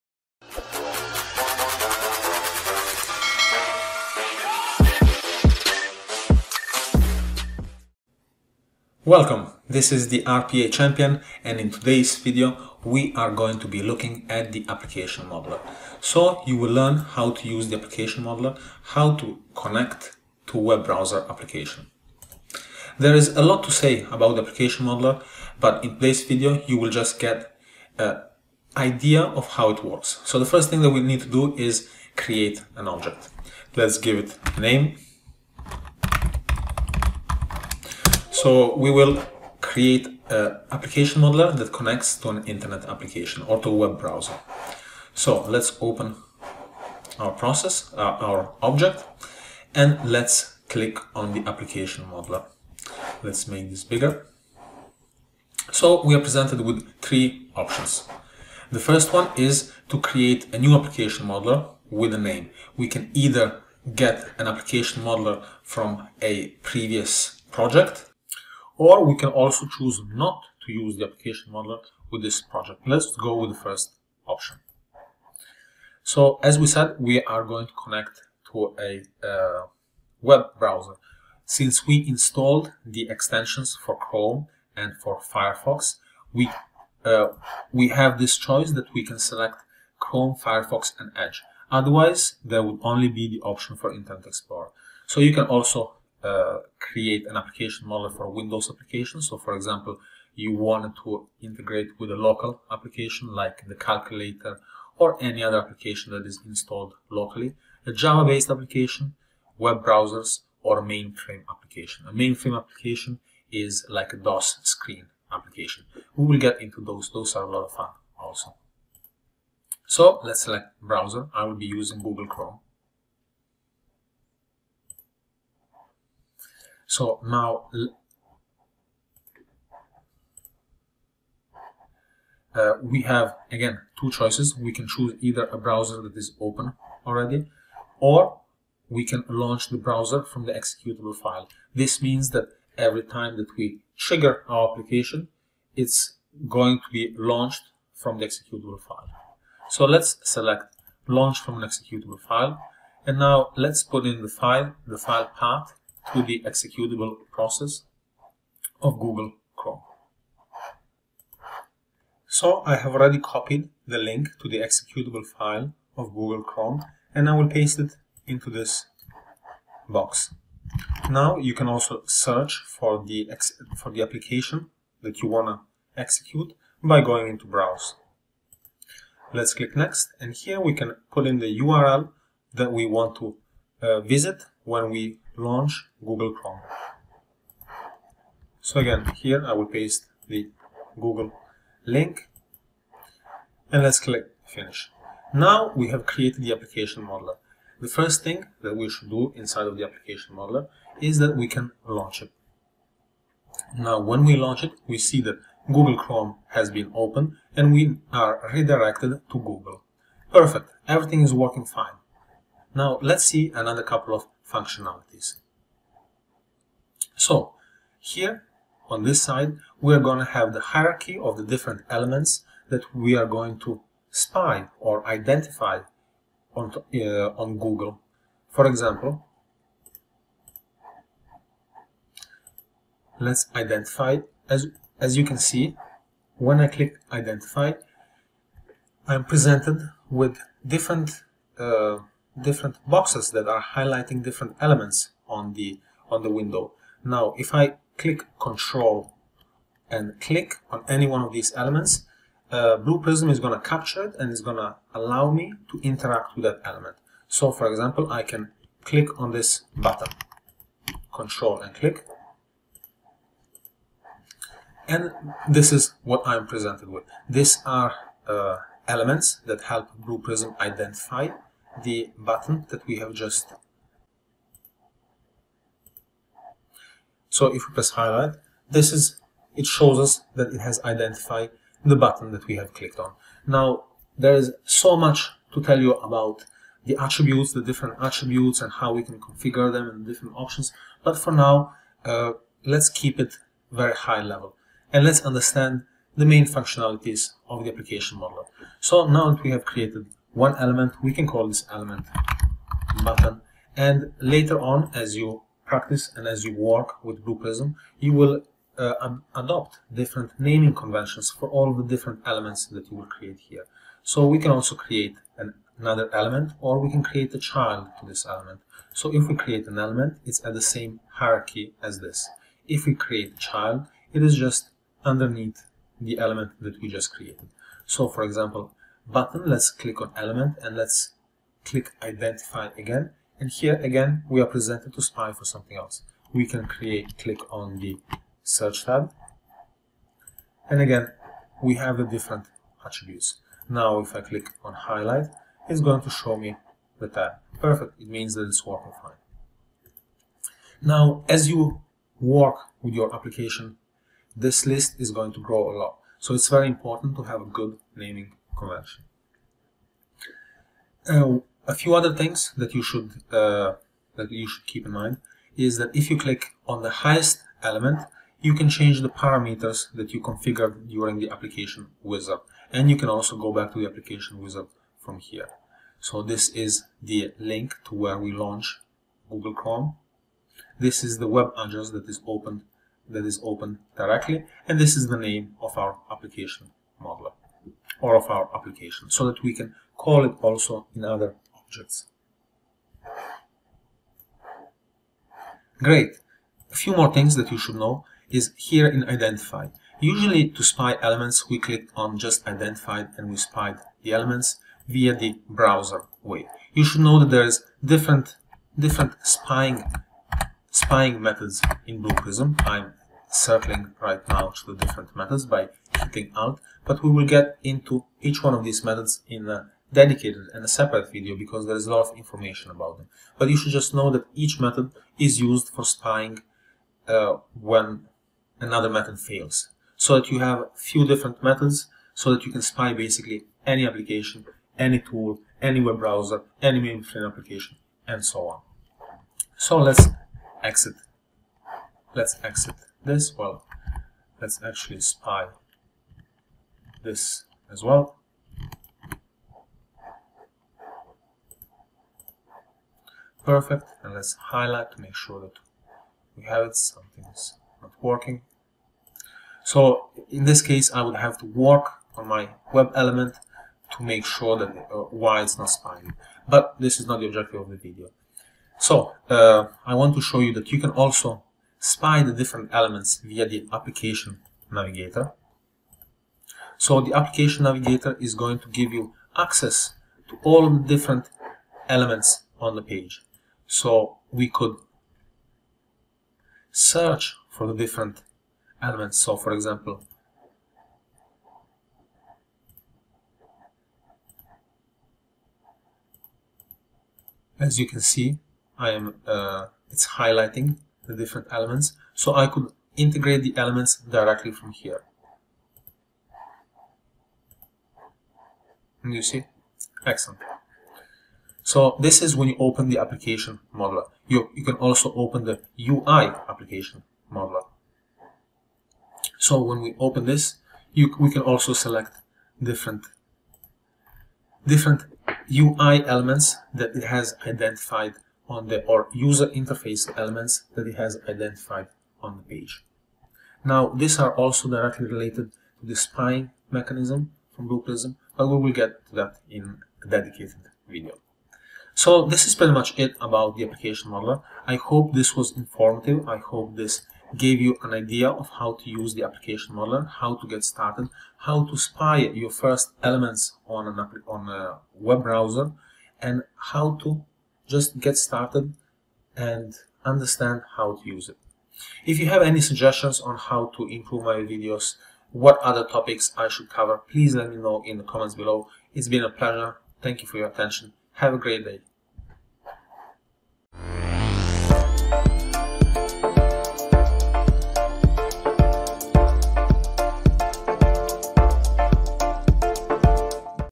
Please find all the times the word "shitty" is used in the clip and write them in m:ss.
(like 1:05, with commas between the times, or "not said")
not said.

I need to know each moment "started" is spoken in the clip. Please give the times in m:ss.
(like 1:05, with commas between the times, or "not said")
9:10, 9:18.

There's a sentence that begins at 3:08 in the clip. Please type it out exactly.
So again, here I will paste the Google link and let's click finish.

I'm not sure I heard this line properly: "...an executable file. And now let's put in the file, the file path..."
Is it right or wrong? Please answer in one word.
right.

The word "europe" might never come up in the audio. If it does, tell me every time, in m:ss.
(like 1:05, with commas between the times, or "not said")
not said.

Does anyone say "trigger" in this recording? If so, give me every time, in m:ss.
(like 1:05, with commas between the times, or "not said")
2:23.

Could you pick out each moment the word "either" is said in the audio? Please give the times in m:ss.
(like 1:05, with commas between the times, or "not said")
1:03, 2:15.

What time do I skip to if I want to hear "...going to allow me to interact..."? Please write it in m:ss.
4:14.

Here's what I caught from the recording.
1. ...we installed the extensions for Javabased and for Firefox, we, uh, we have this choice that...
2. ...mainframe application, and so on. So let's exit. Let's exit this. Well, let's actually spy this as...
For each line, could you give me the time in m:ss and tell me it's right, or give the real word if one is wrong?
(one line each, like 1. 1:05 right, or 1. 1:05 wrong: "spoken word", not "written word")
1. 1:21 wrong: "Chrome", not "Javabased"
2. 7:16 right.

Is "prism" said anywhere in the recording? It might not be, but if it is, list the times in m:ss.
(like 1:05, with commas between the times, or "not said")
4:12, 4:30, 5:07, 6:52, 8:57.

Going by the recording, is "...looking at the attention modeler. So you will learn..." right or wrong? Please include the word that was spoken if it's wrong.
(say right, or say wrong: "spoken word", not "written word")
wrong: "application", not "attention".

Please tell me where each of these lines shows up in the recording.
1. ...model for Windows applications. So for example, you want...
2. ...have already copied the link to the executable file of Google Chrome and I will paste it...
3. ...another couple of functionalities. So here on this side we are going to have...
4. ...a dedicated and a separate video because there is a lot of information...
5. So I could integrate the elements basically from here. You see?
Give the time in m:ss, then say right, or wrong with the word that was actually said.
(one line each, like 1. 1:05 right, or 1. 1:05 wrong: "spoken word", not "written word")
1. 1:37 right
2. 2:42 right
3. 3:33 right
4. 6:59 right
5. 8:22 wrong: "directly", not "basically".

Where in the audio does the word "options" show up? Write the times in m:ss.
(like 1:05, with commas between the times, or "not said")
0:57, 1:14, 1:33, 4:50.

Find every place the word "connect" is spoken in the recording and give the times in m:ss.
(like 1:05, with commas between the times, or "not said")
0:19, 0:41, 1:17.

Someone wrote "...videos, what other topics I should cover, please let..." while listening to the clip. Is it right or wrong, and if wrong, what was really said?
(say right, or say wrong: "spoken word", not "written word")
right.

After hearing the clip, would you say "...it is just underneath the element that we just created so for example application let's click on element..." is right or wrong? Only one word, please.
wrong.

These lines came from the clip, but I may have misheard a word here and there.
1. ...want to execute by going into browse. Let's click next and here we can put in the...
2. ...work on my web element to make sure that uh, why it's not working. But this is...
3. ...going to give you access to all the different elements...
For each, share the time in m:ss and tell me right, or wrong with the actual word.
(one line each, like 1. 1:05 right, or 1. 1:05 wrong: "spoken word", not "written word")
1. 2:55 right
2. 7:41 wrong: "spying", not "working"
3. 7:58 right.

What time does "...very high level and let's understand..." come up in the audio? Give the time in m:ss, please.
4:53.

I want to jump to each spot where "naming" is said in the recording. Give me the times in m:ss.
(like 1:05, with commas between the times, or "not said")
5:10, 5:57.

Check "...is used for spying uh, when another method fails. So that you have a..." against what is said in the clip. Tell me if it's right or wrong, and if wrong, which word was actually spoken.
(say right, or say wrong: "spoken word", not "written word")
right.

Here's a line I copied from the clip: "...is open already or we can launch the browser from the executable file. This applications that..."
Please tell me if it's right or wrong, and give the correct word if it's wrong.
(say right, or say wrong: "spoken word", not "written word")
wrong: "means", not "applications".